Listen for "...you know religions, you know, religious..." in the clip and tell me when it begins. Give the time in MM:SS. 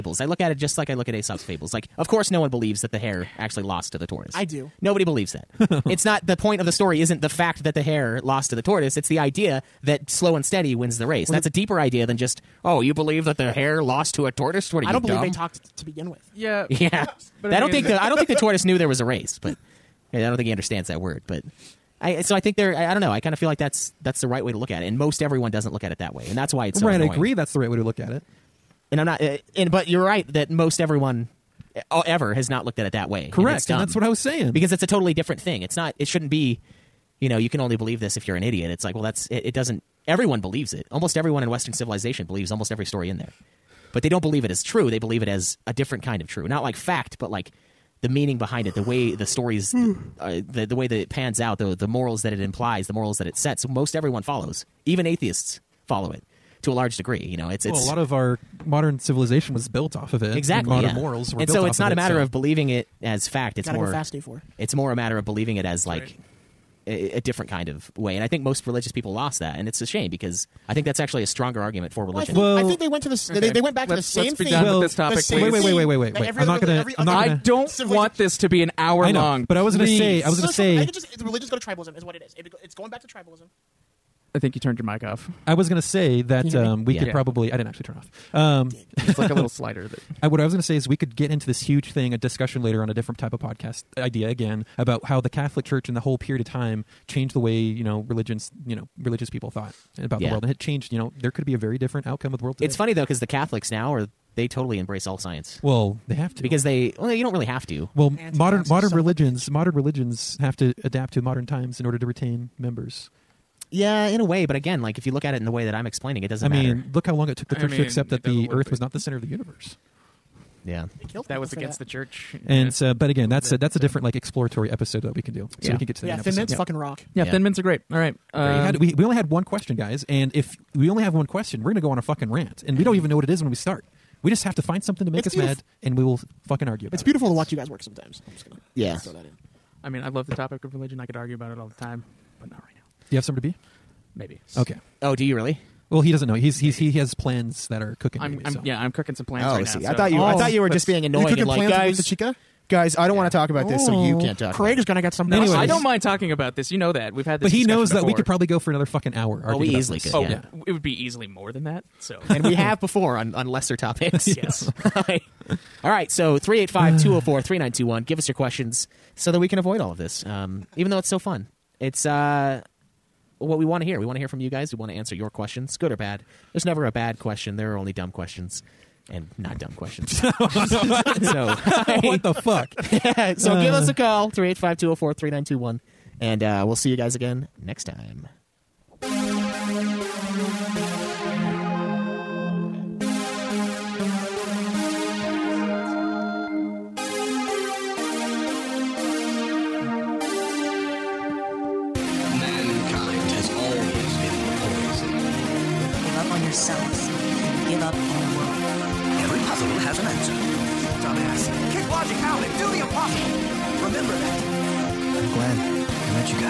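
01:37.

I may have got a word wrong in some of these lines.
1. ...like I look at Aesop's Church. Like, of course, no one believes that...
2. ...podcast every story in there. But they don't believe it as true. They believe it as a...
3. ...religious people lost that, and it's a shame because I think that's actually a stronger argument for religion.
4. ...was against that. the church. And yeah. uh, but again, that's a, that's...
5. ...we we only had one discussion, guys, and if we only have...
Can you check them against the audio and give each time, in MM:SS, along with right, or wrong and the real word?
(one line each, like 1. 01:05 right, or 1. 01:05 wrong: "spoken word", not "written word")
1. 00:00 wrong: "Fables", not "Church"
2. 00:42 wrong: "almost", not "podcast"
3. 01:08 right
4. 02:01 right
5. 02:08 wrong: "question", not "discussion".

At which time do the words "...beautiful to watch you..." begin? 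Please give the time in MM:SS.
02:17.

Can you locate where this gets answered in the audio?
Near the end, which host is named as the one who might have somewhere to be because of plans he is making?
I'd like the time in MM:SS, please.
02:34.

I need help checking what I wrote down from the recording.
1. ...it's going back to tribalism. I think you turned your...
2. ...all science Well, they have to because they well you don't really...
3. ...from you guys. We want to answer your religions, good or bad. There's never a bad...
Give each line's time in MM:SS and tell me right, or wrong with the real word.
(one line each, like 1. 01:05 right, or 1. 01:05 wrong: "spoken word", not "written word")
1. 01:22 right
2. 01:45 right
3. 02:54 wrong: "questions", not "religions".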